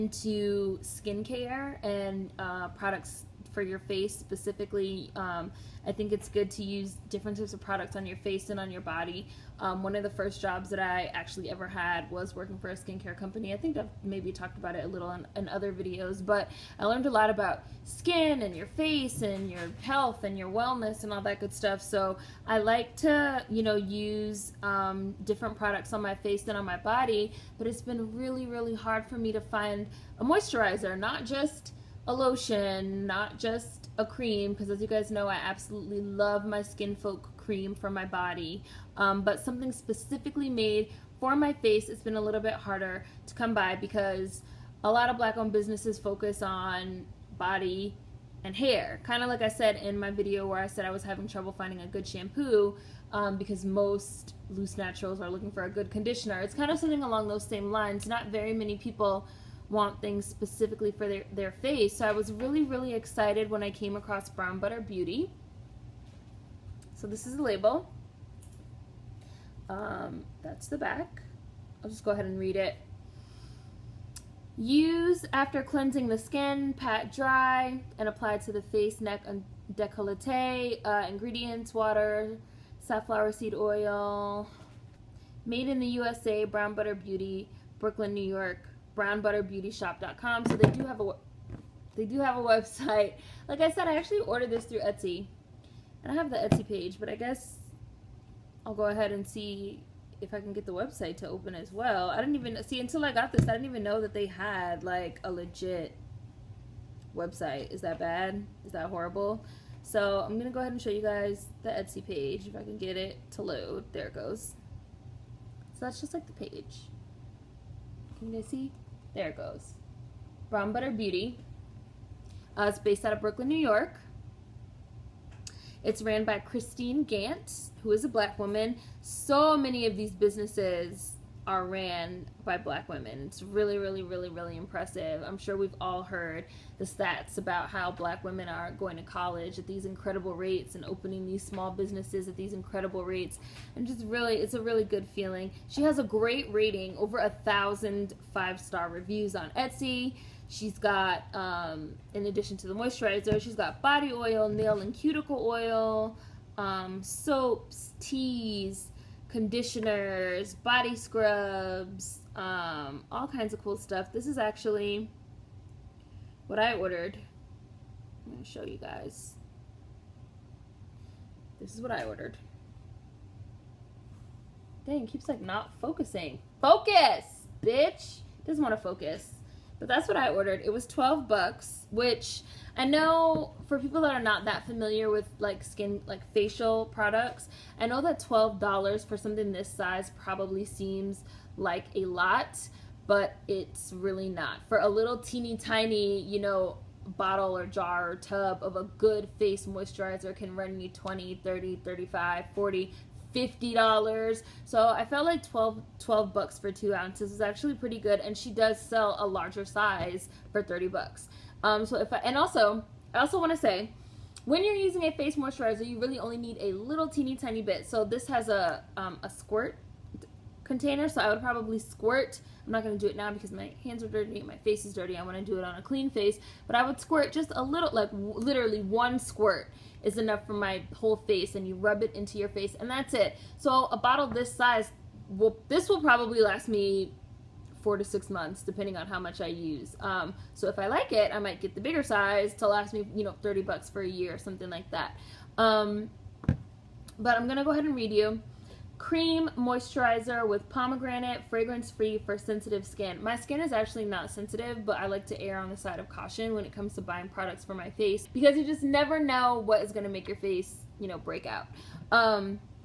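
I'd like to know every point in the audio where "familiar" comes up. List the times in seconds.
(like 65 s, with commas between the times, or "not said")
184 s.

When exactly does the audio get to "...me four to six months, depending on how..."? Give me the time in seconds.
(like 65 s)
236 s.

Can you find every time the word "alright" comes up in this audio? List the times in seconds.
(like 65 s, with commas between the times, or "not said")
not said.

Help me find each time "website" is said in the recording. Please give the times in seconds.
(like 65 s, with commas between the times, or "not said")
92 s, 100 s, 107 s.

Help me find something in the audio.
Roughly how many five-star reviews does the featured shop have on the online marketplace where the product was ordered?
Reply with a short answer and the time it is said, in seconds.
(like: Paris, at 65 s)
over 1,000, at 146 s.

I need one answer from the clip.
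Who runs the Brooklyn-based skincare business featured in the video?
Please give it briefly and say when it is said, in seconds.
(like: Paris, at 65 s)
Christine Gant, at 126 s.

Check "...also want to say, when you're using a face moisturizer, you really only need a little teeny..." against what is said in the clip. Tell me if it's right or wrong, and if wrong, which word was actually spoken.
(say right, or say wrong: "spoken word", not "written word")
right.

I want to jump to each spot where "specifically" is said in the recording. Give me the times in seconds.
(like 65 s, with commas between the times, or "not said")
4 s, 39 s, 60 s.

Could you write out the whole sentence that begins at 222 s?
I'm not going to do it now because my hands are dirty my face is dirty.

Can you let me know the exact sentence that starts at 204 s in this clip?
So I felt like 12, 12 bucks for two ounces is actually pretty good.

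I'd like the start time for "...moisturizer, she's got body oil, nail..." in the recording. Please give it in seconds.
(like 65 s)
152 s.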